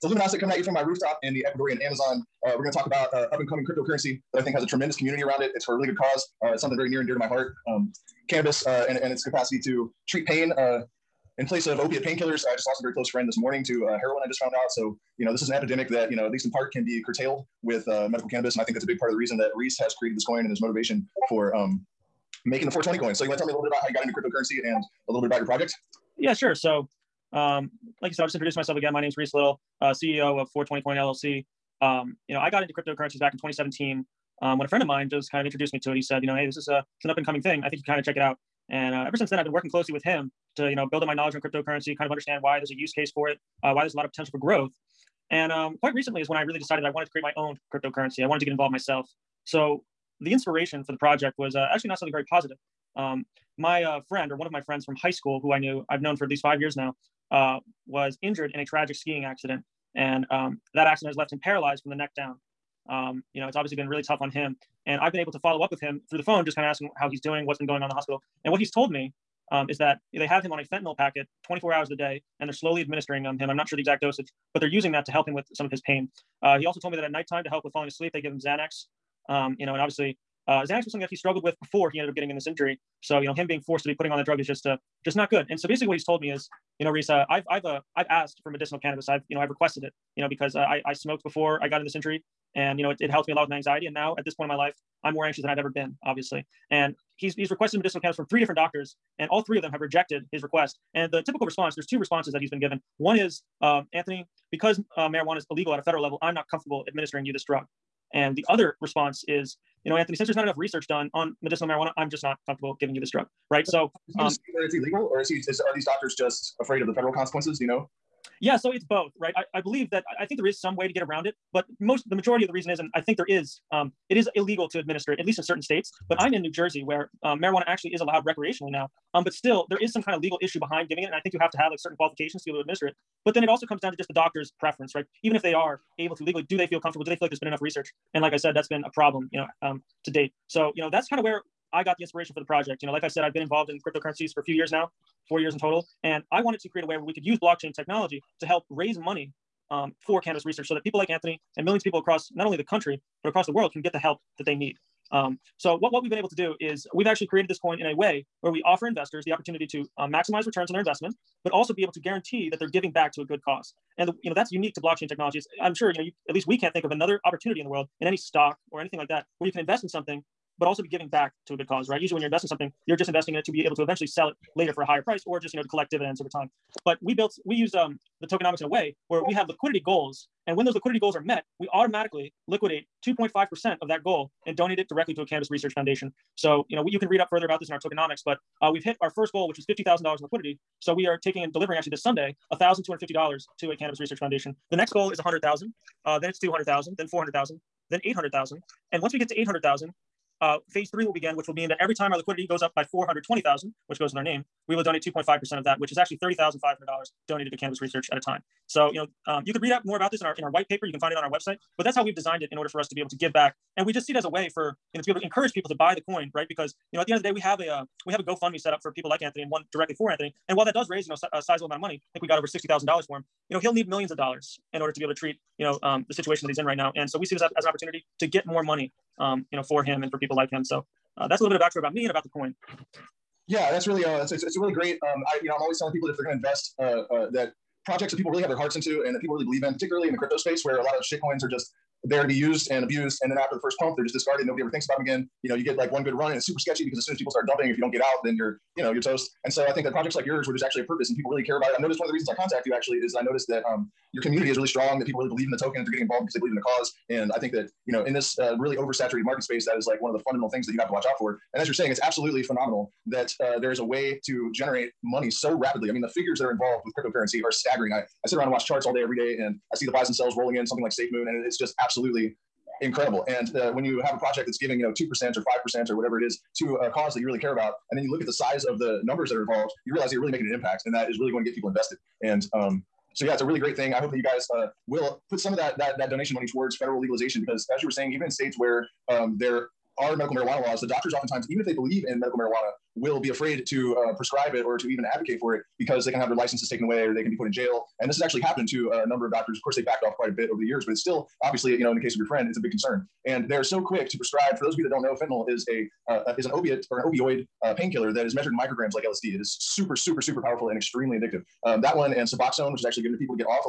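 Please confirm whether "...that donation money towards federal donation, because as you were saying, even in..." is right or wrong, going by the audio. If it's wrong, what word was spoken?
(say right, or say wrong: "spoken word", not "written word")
wrong: "legalization", not "donation".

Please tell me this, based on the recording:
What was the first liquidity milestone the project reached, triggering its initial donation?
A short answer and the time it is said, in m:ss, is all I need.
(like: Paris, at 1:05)
$50,000, at 3:09.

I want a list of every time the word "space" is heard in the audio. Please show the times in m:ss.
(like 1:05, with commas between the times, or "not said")
4:00, 4:19.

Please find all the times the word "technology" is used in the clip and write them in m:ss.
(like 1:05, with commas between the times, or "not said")
2:27, 2:45.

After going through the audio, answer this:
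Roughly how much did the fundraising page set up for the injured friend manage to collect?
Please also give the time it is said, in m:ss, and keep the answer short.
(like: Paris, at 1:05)
$60,000, at 3:42.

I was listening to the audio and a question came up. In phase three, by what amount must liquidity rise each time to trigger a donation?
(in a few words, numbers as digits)
420,000.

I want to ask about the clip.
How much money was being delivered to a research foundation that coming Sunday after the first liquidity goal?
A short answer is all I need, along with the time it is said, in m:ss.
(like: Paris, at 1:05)
$1,250, at 3:12.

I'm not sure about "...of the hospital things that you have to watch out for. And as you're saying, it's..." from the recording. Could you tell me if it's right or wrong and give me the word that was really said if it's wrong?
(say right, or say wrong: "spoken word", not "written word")
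wrong: "fundamental", not "hospital".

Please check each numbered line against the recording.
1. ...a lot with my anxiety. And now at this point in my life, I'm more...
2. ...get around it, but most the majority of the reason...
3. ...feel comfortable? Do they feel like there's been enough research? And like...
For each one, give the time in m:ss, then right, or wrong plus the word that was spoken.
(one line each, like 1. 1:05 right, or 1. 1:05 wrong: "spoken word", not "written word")
1. 1:33 right
2. 2:00 right
3. 2:16 right.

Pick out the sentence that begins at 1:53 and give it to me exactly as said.
So, um, where it's illegal, or is he?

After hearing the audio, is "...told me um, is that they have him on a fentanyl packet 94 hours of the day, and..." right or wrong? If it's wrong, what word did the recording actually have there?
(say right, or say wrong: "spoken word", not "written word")
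wrong: "24", not "94".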